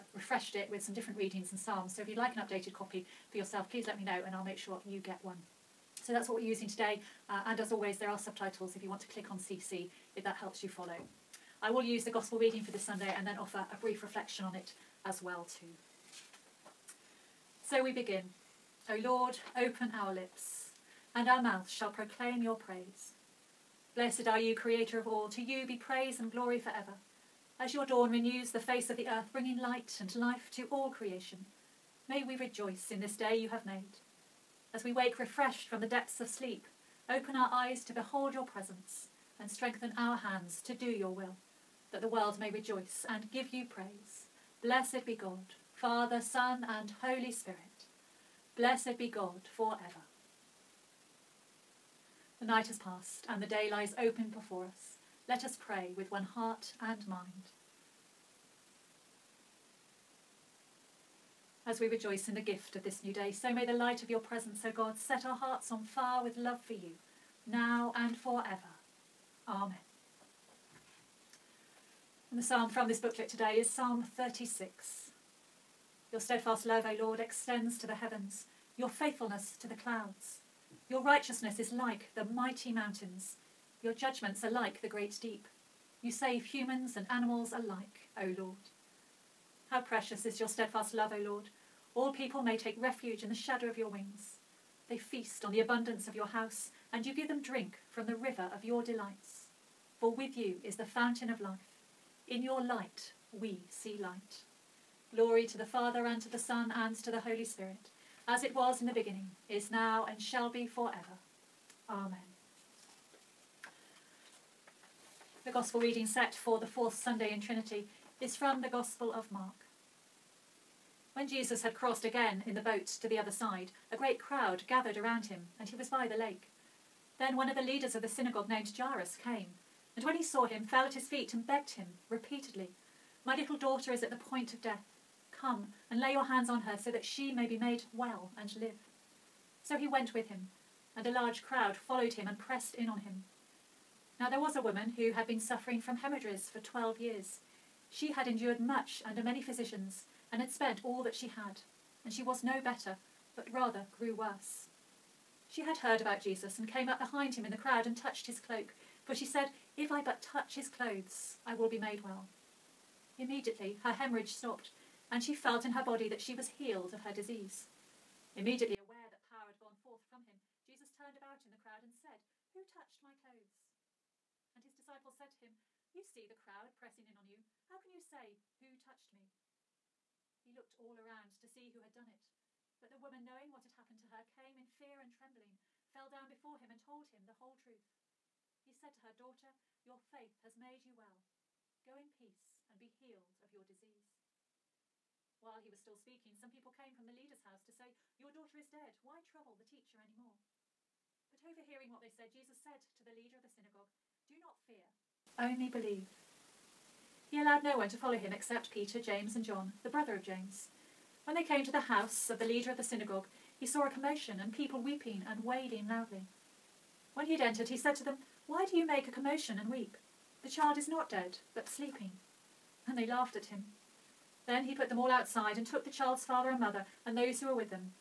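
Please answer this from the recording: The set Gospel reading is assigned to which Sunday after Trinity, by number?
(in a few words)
fourth.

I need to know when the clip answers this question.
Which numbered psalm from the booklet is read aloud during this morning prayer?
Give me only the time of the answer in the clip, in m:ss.
1:13.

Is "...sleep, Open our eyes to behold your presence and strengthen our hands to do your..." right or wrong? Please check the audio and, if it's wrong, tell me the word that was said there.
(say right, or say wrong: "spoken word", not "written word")
right.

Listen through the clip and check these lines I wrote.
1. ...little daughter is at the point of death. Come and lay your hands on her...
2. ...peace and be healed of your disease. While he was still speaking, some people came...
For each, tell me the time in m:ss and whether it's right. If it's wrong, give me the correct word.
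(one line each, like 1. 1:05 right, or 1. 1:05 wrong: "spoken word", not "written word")
1. 2:13 right
2. 3:12 right.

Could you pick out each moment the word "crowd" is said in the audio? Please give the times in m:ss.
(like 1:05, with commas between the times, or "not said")
2:04, 2:21, 2:37, 2:51, 2:56.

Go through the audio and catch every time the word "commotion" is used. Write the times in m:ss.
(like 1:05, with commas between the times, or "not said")
3:33, 3:39.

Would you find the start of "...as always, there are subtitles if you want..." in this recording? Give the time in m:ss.
0:07.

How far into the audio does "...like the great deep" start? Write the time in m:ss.
1:24.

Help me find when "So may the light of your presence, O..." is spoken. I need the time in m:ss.
1:03.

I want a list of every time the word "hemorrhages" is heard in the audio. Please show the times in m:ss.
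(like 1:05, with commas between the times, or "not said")
2:25, 2:43.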